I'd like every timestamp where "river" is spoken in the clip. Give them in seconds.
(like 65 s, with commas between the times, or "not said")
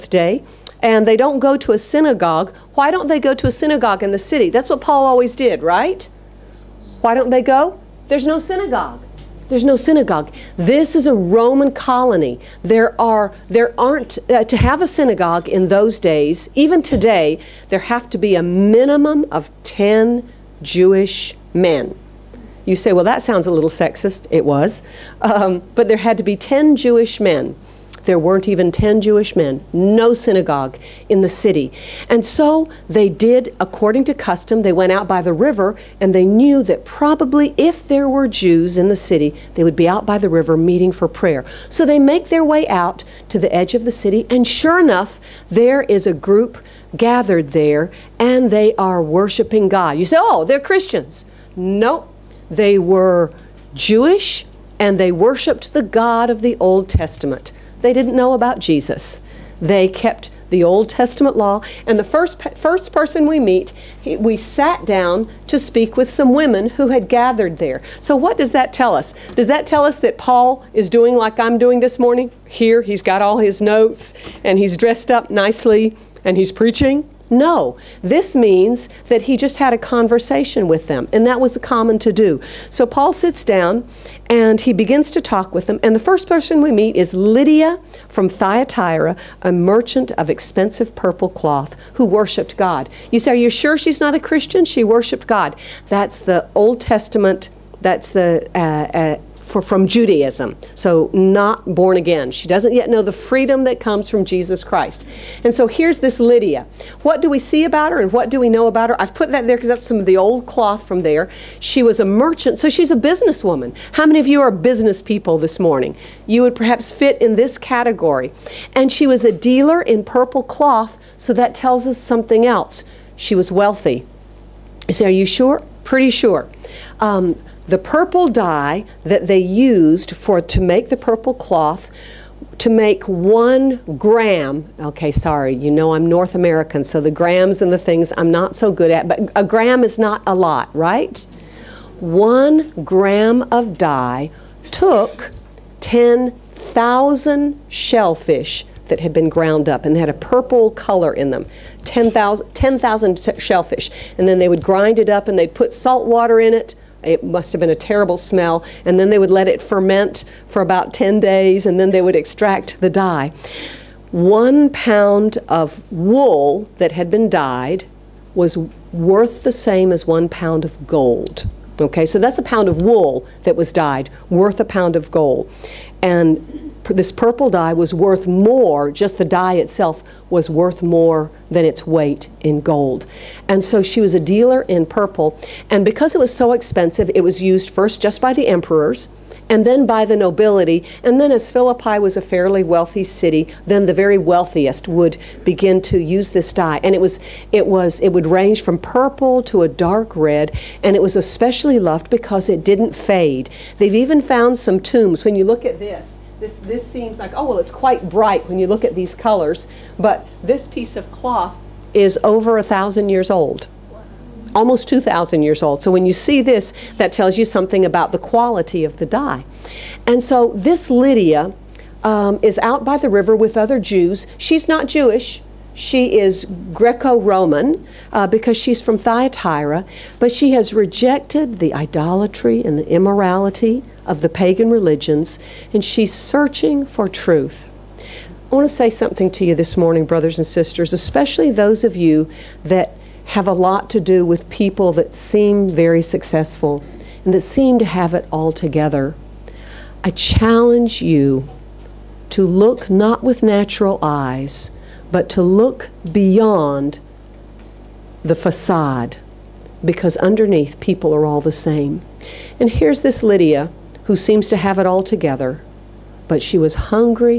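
35 s, 40 s, 223 s.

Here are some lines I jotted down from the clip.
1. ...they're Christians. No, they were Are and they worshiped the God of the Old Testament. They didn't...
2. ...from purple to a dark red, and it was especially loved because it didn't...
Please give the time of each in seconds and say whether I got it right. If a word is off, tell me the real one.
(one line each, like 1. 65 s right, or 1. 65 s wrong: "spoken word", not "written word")
1. 50 s wrong: "Jewish", not "Are"
2. 198 s right.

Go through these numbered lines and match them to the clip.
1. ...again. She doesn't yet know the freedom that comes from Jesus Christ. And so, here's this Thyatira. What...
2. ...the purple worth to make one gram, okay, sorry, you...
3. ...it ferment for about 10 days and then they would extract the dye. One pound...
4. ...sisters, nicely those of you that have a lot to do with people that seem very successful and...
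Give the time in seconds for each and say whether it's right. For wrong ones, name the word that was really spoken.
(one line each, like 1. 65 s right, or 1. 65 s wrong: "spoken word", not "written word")
1. 101 s wrong: "Lydia", not "Thyatira"
2. 130 s wrong: "cloth", not "worth"
3. 159 s right
4. 240 s wrong: "especially", not "nicely".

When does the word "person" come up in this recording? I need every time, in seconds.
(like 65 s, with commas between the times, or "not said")
62 s, 86 s.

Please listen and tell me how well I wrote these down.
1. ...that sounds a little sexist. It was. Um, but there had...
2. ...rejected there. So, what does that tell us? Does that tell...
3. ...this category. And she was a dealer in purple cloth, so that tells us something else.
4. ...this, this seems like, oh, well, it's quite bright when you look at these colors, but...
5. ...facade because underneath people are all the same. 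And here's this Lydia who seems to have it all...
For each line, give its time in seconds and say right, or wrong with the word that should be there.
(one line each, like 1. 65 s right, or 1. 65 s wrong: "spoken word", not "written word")
1. 23 s right
2. 67 s wrong: "gathered", not "rejected"
3. 117 s right
4. 206 s right
5. 258 s right.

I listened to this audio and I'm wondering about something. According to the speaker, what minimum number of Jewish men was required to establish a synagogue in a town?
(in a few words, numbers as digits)
10.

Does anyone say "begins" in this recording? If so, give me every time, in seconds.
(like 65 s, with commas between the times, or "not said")
84 s, 195 s.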